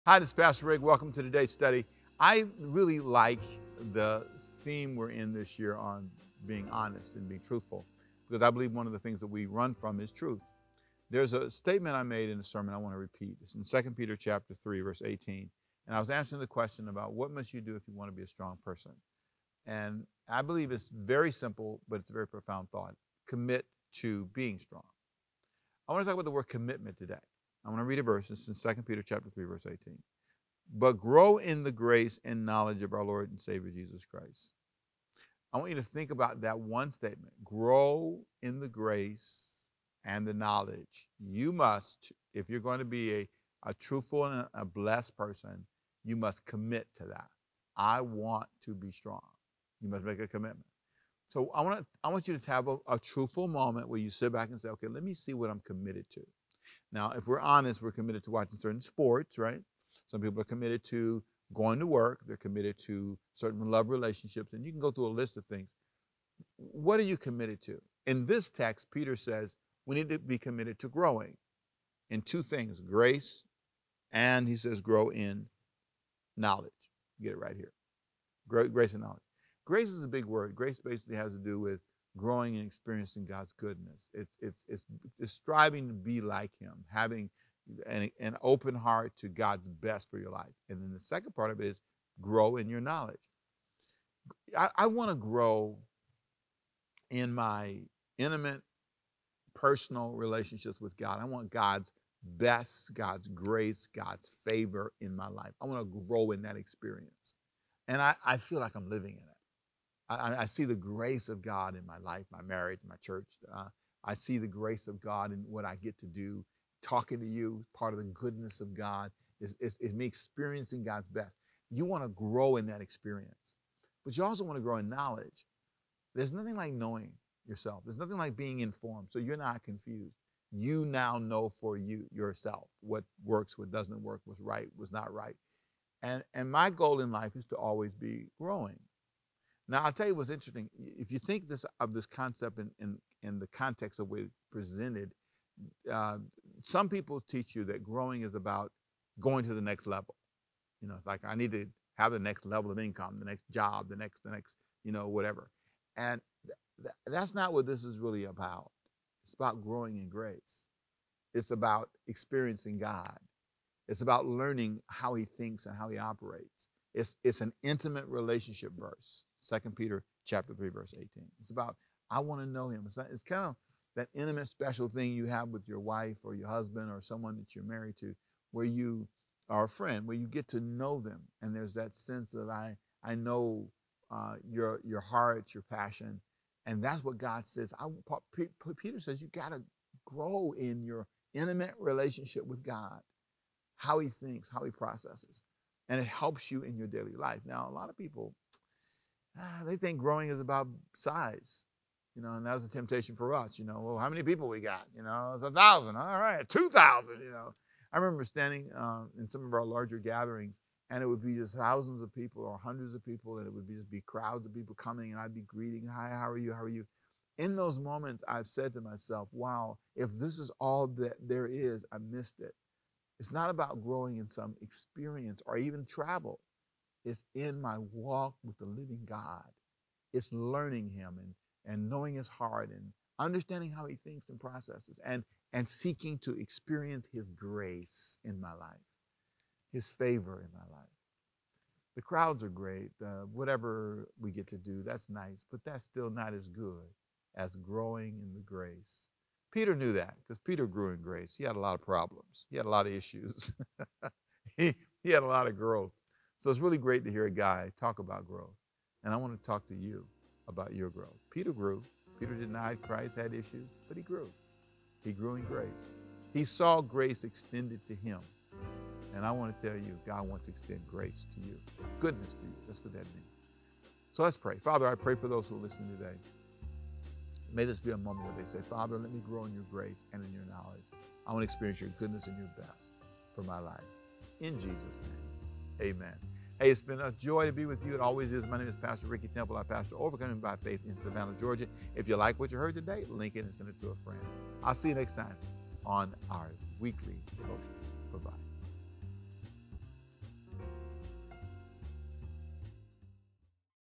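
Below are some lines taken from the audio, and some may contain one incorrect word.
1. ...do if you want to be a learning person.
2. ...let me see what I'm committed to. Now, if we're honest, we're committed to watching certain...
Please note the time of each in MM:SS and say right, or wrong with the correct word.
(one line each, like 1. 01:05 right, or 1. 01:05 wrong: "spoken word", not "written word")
1. 00:17 wrong: "strong", not "learning"
2. 00:54 right.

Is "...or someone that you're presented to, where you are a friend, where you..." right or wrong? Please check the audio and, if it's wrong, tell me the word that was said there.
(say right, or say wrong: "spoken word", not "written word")
wrong: "married", not "presented".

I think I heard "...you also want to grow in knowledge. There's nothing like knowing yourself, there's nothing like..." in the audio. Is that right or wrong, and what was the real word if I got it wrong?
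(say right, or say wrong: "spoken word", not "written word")
right.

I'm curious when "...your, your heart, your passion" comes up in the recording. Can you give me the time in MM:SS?
03:04.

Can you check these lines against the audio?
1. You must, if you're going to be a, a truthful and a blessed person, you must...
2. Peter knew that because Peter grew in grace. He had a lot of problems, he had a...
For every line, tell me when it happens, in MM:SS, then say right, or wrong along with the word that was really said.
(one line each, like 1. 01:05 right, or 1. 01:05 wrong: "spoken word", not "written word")
1. 00:41 right
2. 04:09 right.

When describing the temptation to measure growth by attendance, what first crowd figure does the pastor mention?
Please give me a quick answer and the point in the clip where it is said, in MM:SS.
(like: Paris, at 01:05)
1000, at 03:25.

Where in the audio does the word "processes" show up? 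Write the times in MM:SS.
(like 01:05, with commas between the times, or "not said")
03:14, 03:54.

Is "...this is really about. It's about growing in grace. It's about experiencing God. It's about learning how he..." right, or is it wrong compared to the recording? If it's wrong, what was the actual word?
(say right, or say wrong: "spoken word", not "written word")
right.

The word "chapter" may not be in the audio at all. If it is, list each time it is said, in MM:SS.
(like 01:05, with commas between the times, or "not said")
00:14, 00:29, 02:50.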